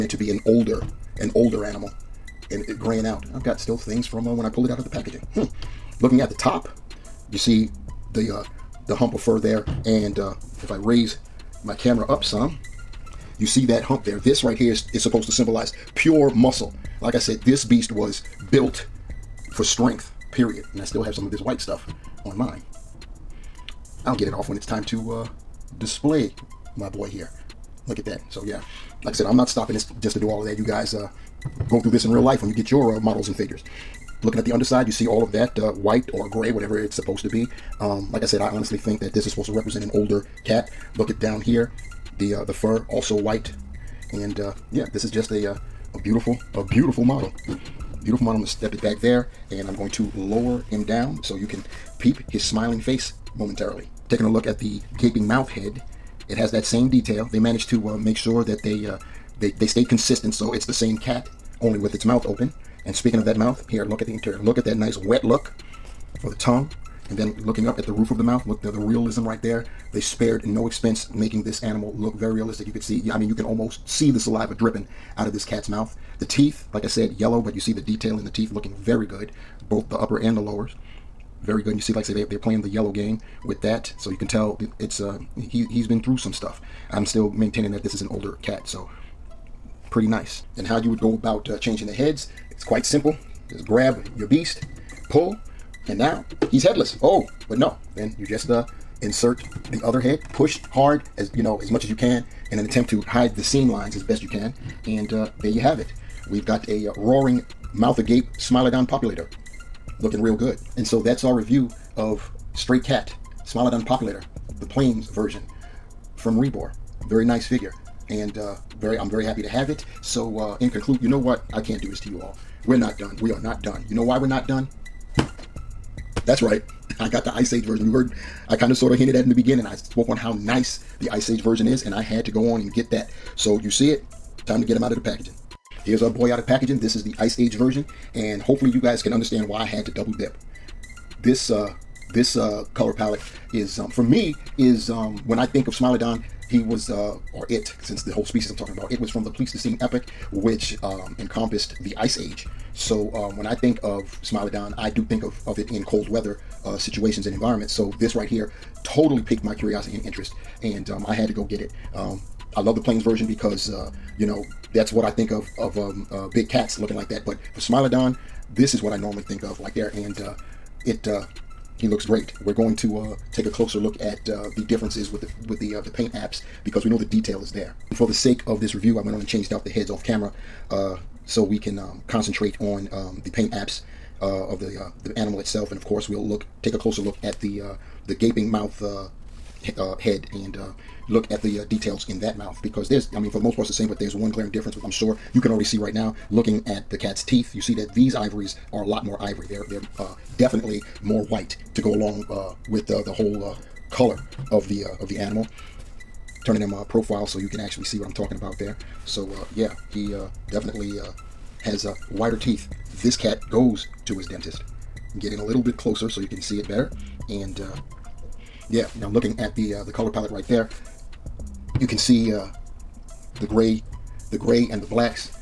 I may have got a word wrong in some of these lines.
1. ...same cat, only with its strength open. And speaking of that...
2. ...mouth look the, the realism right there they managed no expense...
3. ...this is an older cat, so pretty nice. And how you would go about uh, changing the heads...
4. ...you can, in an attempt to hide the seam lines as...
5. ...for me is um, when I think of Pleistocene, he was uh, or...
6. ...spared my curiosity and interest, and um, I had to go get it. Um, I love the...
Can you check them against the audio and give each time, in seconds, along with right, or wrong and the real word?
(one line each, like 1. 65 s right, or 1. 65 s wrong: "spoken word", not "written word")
1. 60 s wrong: "mouth", not "strength"
2. 68 s wrong: "spared", not "managed"
3. 87 s right
4. 101 s right
5. 143 s wrong: "Smilodon", not "Pleistocene"
6. 159 s wrong: "piqued", not "spared".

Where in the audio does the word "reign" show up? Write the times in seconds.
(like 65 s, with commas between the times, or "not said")
not said.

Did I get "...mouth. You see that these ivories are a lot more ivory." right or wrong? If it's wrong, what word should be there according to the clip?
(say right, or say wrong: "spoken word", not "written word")
wrong: "teeth", not "mouth".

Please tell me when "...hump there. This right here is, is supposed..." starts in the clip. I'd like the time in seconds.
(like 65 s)
13 s.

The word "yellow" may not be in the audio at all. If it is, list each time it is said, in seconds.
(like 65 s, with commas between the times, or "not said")
77 s, 82 s.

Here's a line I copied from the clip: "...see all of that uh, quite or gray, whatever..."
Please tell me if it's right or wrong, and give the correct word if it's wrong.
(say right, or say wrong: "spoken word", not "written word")
wrong: "white", not "quite".